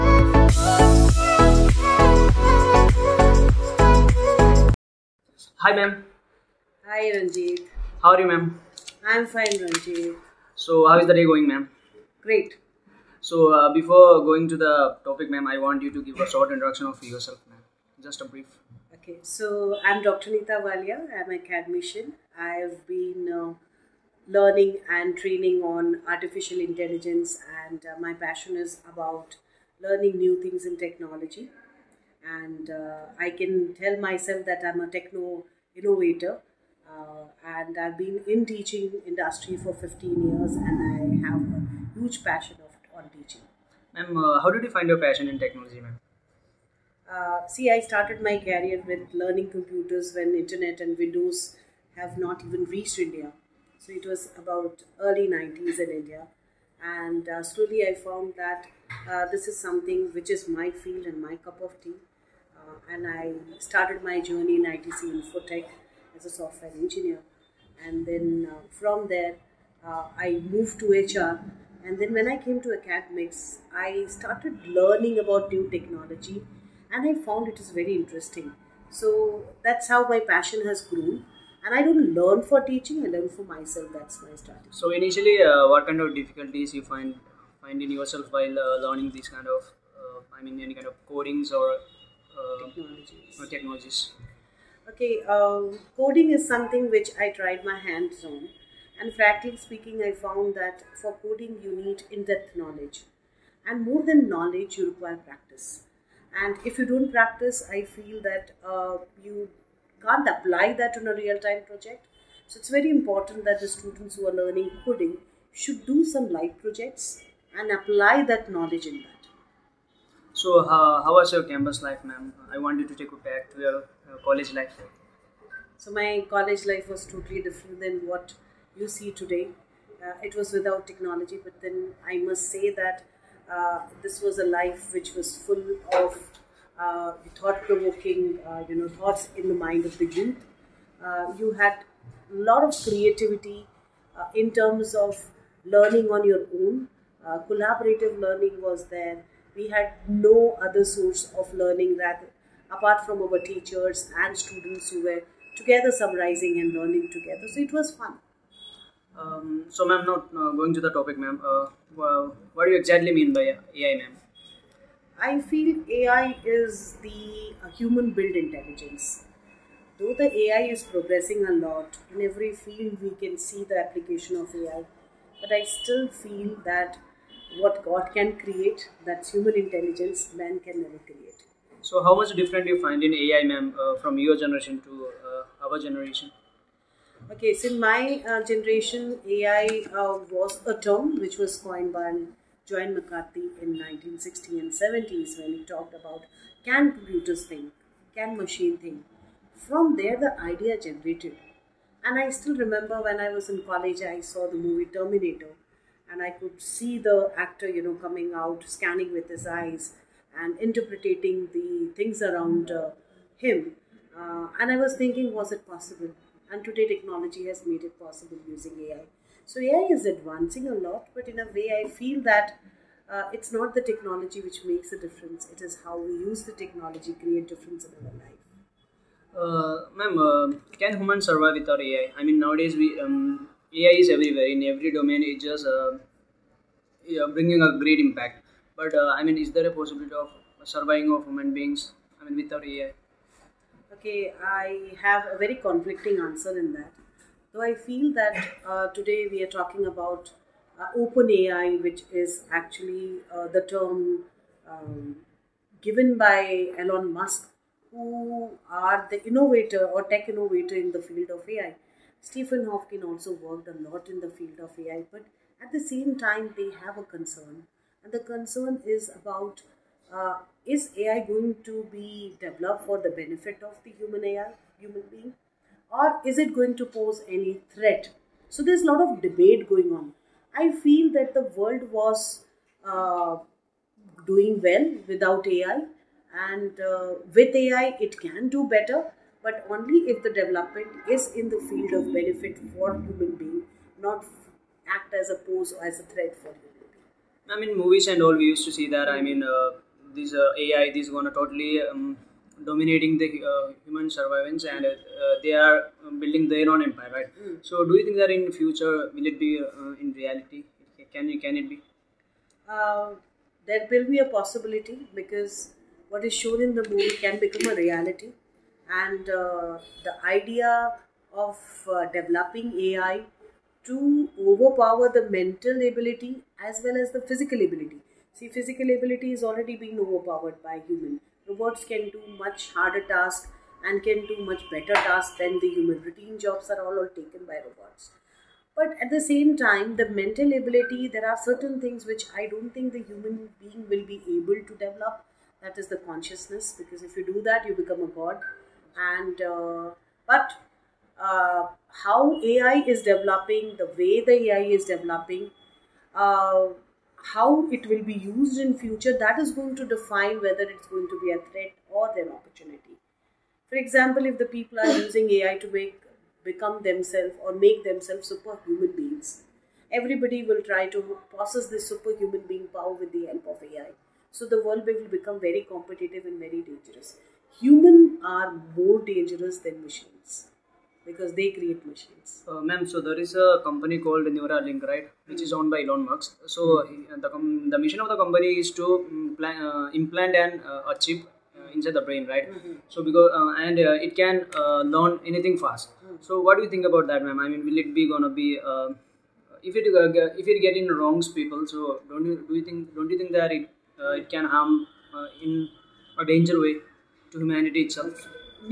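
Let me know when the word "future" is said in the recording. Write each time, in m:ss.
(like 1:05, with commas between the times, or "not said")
5:08, 5:58.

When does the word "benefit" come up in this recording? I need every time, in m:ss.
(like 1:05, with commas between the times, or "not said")
4:33, 4:52.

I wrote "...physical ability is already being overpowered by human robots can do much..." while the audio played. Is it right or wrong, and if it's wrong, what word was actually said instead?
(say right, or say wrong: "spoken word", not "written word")
right.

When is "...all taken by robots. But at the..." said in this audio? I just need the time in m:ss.
5:36.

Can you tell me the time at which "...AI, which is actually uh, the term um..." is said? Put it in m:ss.
4:11.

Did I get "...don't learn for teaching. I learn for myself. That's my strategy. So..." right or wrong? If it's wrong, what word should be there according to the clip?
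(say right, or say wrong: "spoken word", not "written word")
right.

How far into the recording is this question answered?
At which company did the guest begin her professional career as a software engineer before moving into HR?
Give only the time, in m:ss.
1:04.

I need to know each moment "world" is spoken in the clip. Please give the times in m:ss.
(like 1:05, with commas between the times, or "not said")
4:41, 6:14.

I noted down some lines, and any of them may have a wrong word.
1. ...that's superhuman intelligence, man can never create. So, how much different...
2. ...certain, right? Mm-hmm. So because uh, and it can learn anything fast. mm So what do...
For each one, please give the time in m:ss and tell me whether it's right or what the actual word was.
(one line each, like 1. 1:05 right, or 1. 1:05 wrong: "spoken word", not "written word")
1. 2:59 wrong: "human", not "superhuman"
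2. 6:32 wrong: "brain", not "certain".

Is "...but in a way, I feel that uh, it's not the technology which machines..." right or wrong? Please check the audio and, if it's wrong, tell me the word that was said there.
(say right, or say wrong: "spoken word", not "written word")
wrong: "makes", not "machines".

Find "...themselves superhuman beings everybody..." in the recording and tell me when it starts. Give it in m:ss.
6:07.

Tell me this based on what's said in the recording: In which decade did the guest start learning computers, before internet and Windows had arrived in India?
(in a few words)
early 90s.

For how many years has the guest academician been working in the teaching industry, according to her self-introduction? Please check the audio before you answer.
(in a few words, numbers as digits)
15 years.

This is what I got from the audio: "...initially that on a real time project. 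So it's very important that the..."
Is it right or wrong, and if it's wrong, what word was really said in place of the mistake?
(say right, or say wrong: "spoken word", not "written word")
wrong: "apply", not "initially".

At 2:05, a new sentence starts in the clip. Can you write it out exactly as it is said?
So, my college life was totally different than what you see today.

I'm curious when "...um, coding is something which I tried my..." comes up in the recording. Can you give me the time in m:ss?
1:35.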